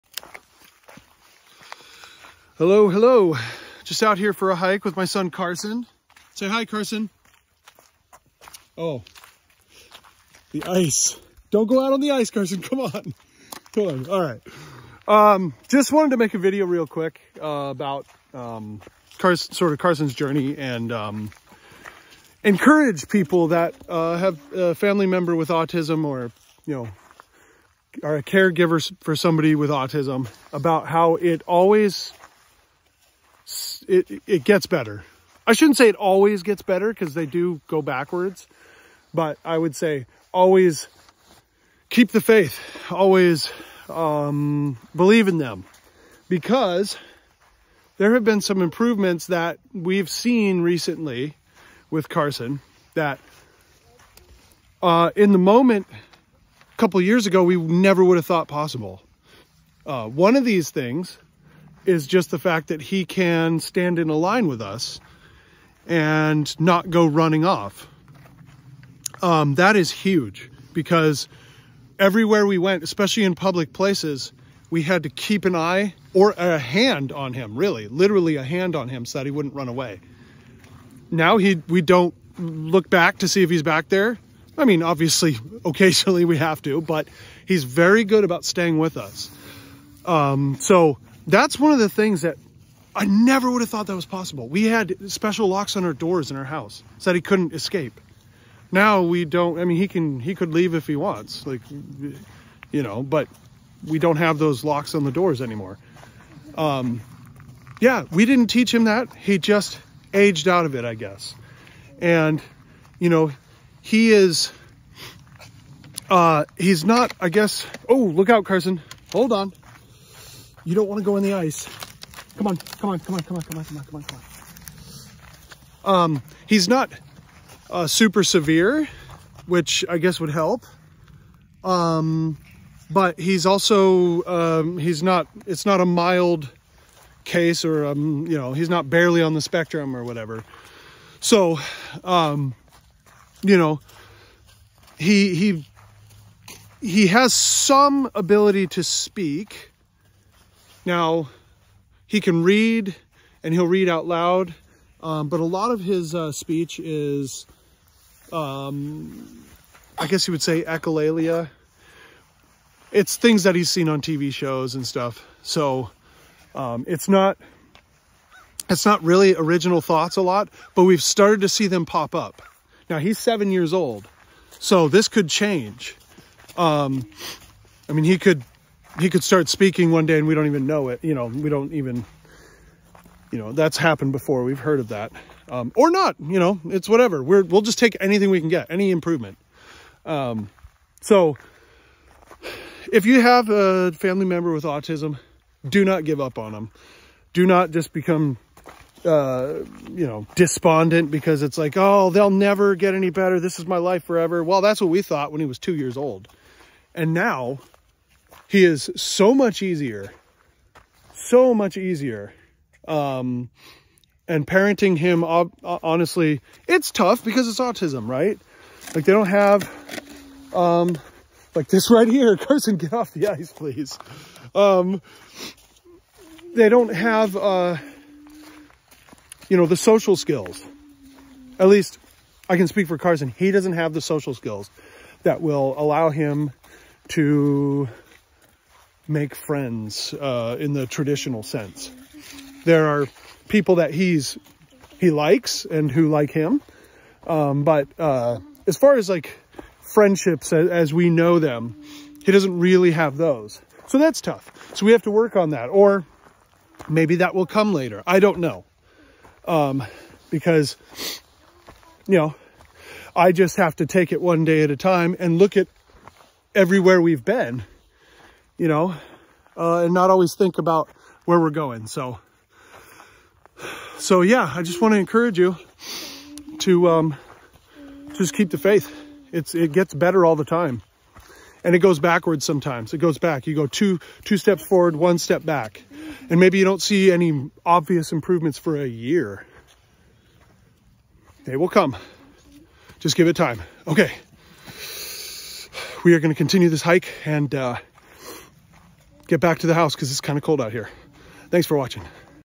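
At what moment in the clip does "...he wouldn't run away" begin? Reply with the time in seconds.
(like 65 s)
79 s.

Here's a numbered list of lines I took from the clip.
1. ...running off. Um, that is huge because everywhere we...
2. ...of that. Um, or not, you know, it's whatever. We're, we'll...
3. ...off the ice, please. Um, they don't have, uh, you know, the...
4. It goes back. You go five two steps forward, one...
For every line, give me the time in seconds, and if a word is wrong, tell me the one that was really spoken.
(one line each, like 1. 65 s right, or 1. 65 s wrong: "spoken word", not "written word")
1. 67 s right
2. 184 s right
3. 222 s right
4. 282 s wrong: "two", not "five".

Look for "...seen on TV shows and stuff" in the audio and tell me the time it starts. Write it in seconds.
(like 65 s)
163 s.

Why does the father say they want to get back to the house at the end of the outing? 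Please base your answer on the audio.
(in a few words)
it's kind of cold.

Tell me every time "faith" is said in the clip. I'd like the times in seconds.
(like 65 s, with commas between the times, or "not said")
42 s, 278 s.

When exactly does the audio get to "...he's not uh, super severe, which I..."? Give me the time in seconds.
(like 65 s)
126 s.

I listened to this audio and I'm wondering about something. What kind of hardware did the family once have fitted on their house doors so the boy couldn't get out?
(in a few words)
special locks.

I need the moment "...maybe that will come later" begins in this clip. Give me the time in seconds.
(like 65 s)
256 s.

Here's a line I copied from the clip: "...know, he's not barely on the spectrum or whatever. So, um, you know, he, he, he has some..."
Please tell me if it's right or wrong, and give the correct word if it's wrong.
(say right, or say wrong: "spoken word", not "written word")
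right.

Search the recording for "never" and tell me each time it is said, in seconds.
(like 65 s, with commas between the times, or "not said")
57 s, 93 s, 202 s.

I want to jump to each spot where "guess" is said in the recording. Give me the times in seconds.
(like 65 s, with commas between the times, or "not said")
110 s, 117 s, 129 s, 160 s.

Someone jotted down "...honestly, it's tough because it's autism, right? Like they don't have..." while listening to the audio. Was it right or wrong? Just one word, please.
right.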